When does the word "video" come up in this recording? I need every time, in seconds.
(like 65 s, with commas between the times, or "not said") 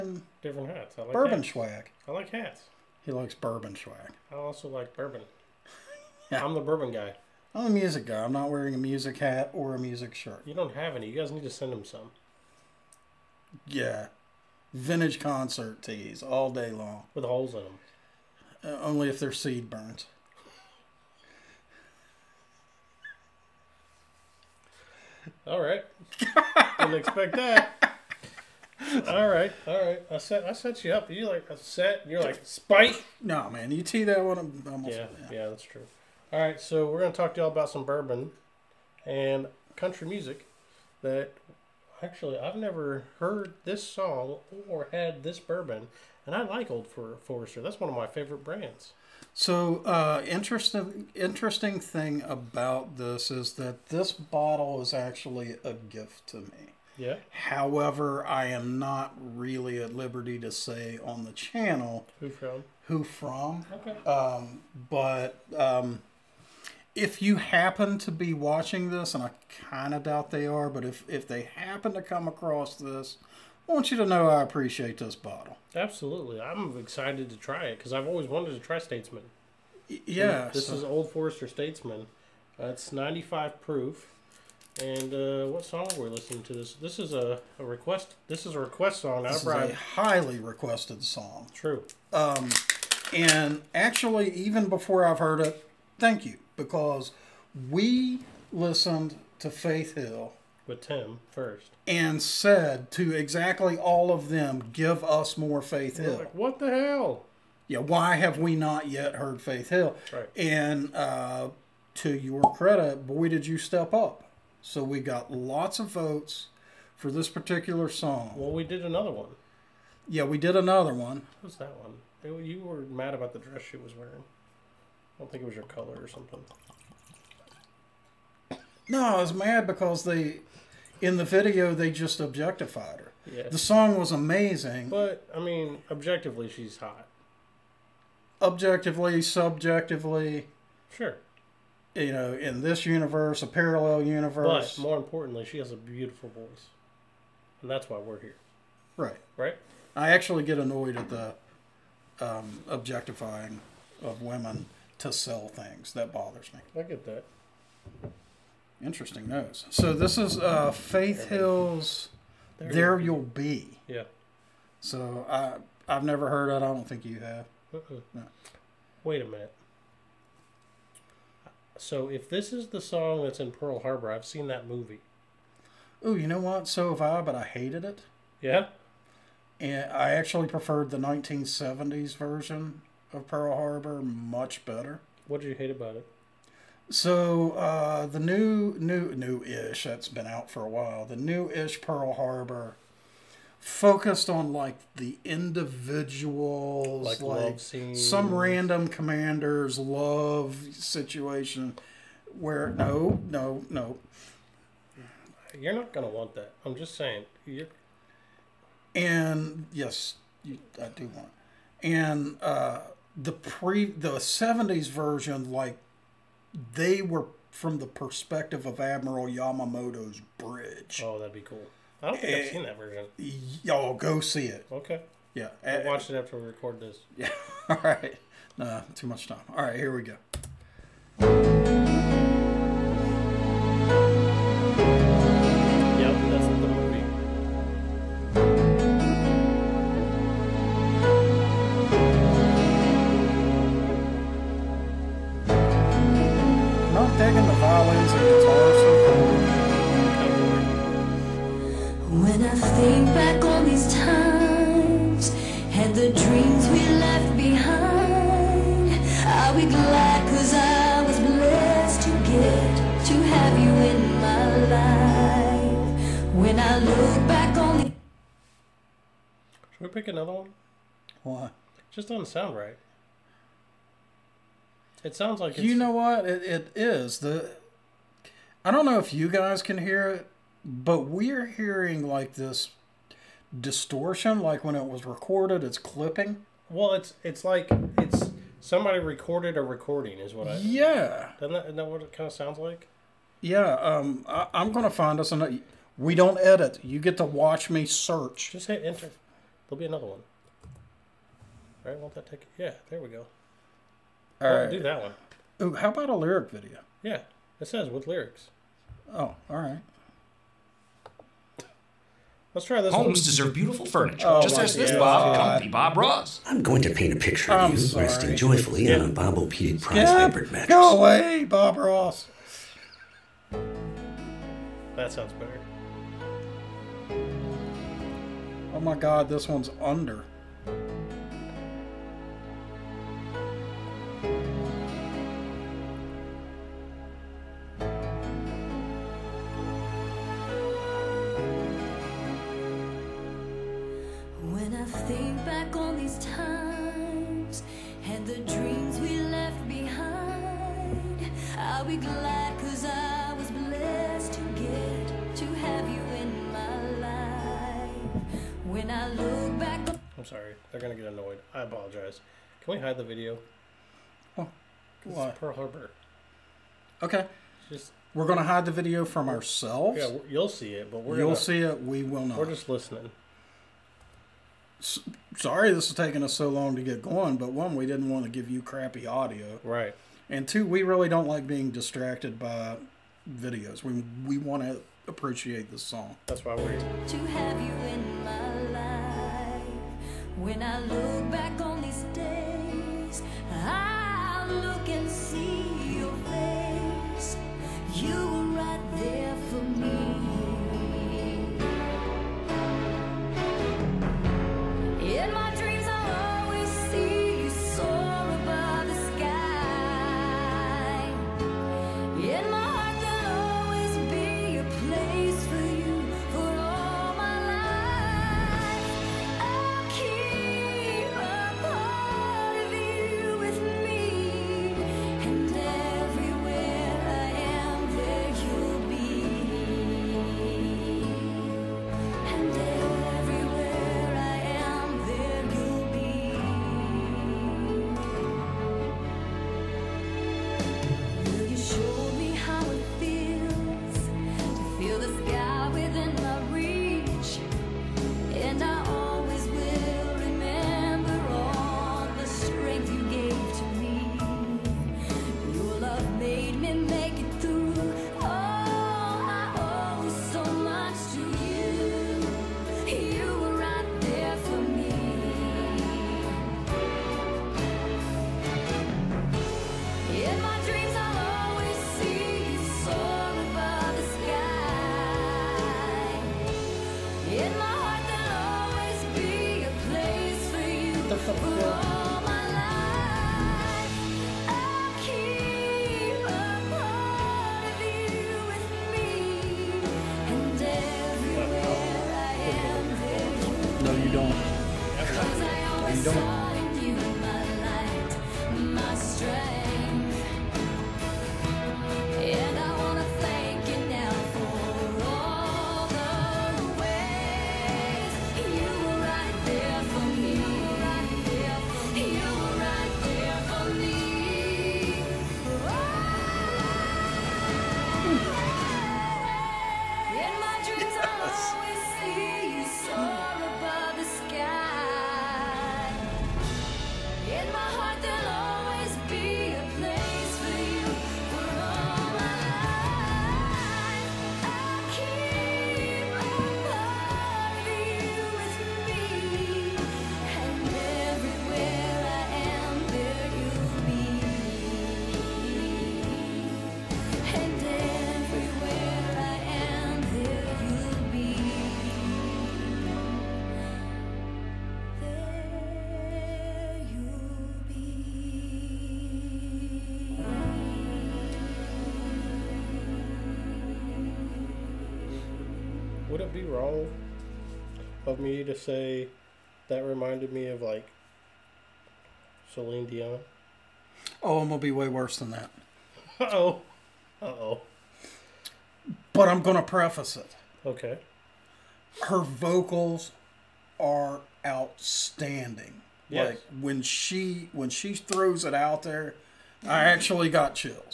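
131 s, 306 s, 363 s, 368 s, 383 s.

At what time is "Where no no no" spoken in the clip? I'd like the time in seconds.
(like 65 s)
202 s.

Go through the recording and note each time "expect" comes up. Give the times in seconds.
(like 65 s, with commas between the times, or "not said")
26 s.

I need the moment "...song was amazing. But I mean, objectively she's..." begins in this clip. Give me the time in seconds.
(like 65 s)
133 s.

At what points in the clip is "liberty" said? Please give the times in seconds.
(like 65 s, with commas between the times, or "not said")
59 s.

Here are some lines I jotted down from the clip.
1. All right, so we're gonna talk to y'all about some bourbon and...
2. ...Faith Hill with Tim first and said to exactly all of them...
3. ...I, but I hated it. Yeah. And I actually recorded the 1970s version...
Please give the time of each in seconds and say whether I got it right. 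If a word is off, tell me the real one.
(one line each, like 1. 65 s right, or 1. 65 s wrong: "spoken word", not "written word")
1. 36 s right
2. 99 s right
3. 177 s wrong: "preferred", not "recorded".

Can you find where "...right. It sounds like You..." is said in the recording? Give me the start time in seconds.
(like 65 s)
272 s.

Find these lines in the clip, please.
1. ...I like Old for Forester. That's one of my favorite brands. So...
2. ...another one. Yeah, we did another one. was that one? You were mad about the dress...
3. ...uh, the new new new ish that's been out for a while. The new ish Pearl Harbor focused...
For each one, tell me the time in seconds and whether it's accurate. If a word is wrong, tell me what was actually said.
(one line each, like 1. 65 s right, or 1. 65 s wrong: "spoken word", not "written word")
1. 46 s right
2. 118 s right
3. 187 s right.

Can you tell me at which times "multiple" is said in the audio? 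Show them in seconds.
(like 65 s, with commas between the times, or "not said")
not said.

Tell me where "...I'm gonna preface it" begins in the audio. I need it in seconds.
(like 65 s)
579 s.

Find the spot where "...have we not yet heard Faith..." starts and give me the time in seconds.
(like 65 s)
108 s.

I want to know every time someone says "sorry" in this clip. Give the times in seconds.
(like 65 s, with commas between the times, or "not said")
317 s, 375 s.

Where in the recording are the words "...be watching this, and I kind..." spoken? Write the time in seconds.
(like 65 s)
68 s.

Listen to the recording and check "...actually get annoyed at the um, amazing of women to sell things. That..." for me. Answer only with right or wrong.
wrong.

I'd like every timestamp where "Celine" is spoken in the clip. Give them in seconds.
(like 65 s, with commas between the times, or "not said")
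572 s.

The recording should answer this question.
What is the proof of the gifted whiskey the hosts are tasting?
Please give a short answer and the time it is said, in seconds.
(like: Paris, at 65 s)
95, at 82 s.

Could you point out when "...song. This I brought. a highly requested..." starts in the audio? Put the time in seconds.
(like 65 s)
89 s.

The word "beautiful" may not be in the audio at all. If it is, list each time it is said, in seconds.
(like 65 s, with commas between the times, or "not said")
145 s, 313 s.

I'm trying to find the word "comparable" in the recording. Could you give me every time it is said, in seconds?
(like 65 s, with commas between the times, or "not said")
not said.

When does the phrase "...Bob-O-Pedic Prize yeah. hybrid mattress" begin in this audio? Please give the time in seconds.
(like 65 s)
319 s.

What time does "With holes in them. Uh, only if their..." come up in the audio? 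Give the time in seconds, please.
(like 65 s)
17 s.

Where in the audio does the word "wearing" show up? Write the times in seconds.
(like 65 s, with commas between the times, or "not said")
8 s, 123 s.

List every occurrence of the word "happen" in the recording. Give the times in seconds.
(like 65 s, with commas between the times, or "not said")
67 s, 71 s.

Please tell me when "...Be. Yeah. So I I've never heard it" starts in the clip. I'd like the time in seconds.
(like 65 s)
163 s.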